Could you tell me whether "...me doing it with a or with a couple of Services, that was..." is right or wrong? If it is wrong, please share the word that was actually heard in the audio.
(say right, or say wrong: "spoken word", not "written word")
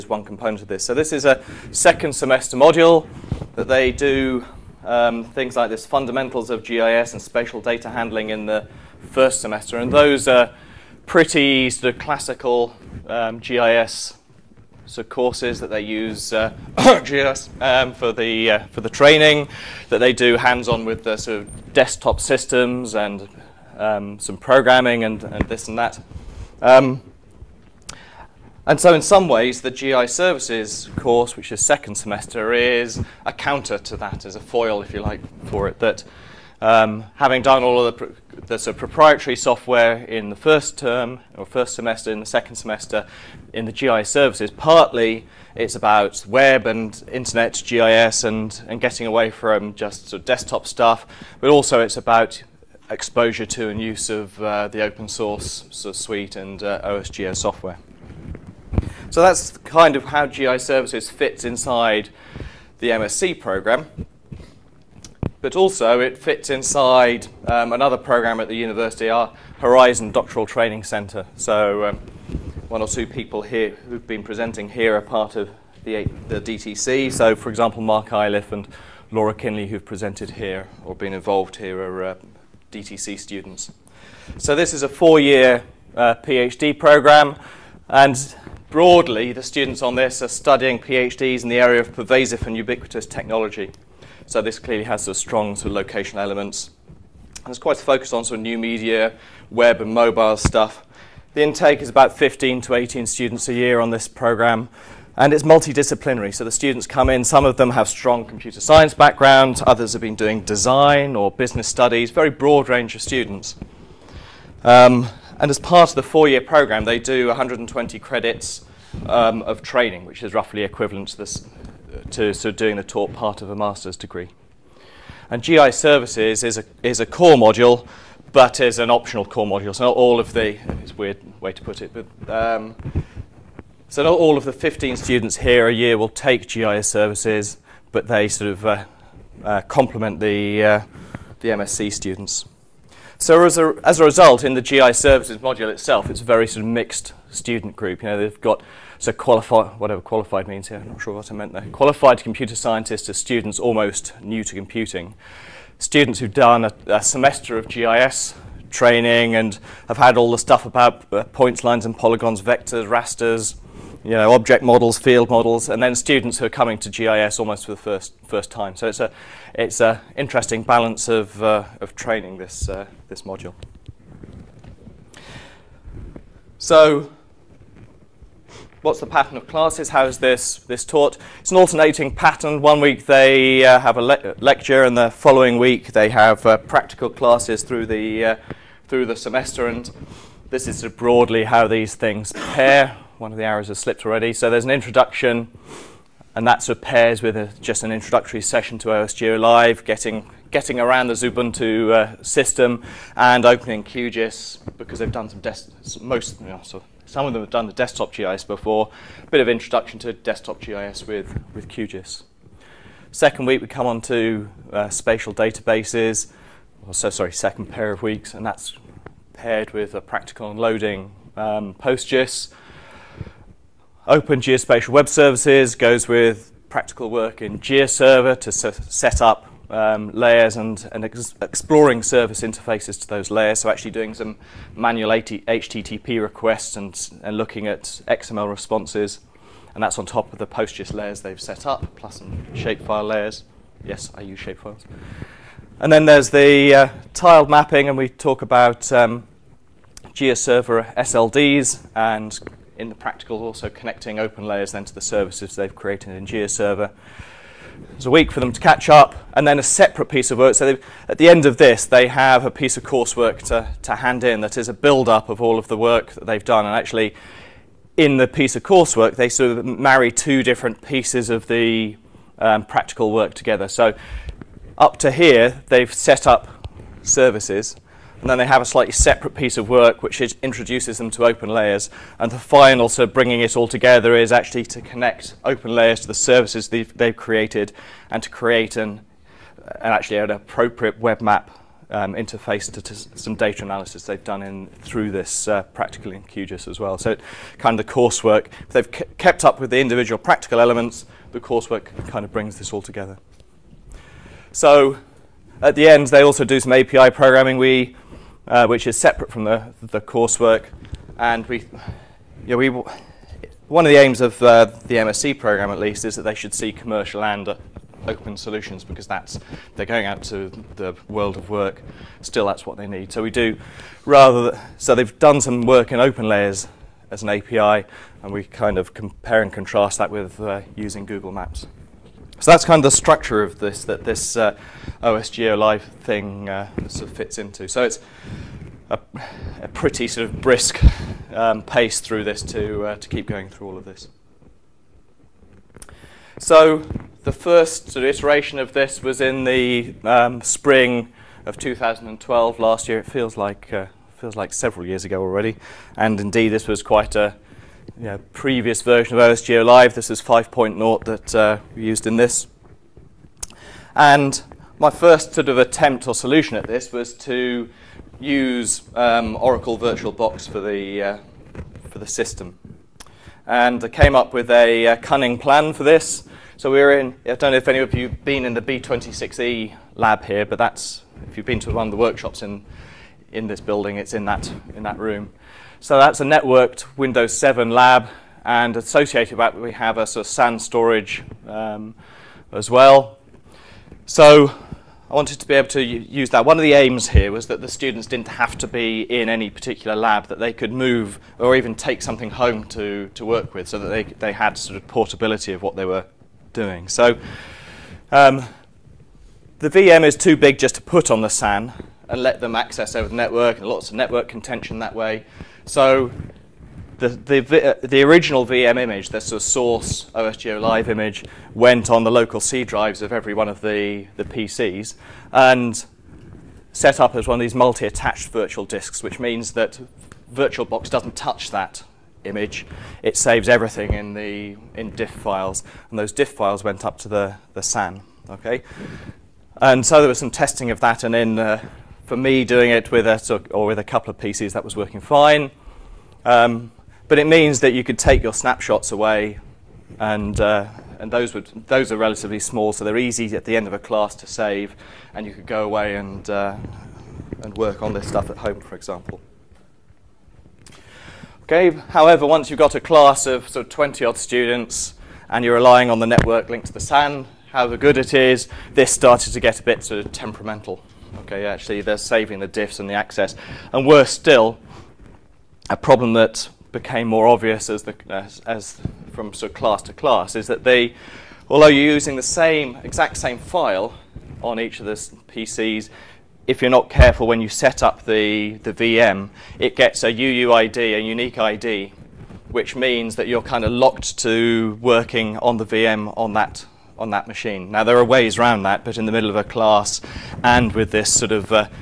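wrong: "PCs", not "Services".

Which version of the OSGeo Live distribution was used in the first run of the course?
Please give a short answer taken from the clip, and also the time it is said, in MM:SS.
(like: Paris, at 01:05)
5.0, at 06:00.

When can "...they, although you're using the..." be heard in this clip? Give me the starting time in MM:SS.
08:00.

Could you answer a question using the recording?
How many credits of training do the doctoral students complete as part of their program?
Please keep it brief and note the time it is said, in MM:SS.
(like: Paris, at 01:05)
120, at 01:57.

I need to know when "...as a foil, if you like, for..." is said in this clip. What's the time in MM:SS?
00:34.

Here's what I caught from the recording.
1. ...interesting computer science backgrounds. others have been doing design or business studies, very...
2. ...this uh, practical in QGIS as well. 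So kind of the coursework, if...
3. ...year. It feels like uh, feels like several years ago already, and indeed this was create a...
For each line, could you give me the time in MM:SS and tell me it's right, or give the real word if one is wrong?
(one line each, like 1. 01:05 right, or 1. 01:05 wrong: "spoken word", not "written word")
1. 01:47 wrong: "strong", not "interesting"
2. 04:55 right
3. 05:52 wrong: "quite", not "create".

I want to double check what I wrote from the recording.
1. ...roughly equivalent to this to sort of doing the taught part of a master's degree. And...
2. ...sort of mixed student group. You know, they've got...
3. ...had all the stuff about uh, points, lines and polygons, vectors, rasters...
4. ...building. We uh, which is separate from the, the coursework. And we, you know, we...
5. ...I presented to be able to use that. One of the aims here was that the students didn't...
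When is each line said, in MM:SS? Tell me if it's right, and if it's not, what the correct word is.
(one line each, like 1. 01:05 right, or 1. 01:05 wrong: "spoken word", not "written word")
1. 02:00 right
2. 02:26 right
3. 02:39 right
4. 05:07 wrong: "programming", not "building"
5. 06:35 wrong: "wanted", not "presented".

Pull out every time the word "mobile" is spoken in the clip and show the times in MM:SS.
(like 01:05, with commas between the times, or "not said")
01:39.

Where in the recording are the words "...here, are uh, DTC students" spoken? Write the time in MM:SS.
01:21.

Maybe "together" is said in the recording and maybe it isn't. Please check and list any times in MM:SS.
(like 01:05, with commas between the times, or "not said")
04:33, 04:43, 05:02.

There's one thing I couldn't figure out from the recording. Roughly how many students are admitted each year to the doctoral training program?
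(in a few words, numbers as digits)
15 to 18.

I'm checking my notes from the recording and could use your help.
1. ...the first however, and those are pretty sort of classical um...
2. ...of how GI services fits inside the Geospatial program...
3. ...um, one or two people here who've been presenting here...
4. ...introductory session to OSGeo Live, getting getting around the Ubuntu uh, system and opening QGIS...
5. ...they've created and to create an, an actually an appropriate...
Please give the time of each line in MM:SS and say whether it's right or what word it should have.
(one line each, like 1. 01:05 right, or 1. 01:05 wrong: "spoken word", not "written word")
1. 00:08 wrong: "semester", not "however"
2. 00:59 wrong: "MSc", not "Geospatial"
3. 01:11 right
4. 03:17 right
5. 04:46 right.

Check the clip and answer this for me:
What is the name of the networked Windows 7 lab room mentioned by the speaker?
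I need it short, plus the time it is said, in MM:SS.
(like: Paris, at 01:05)
B26E, at 06:18.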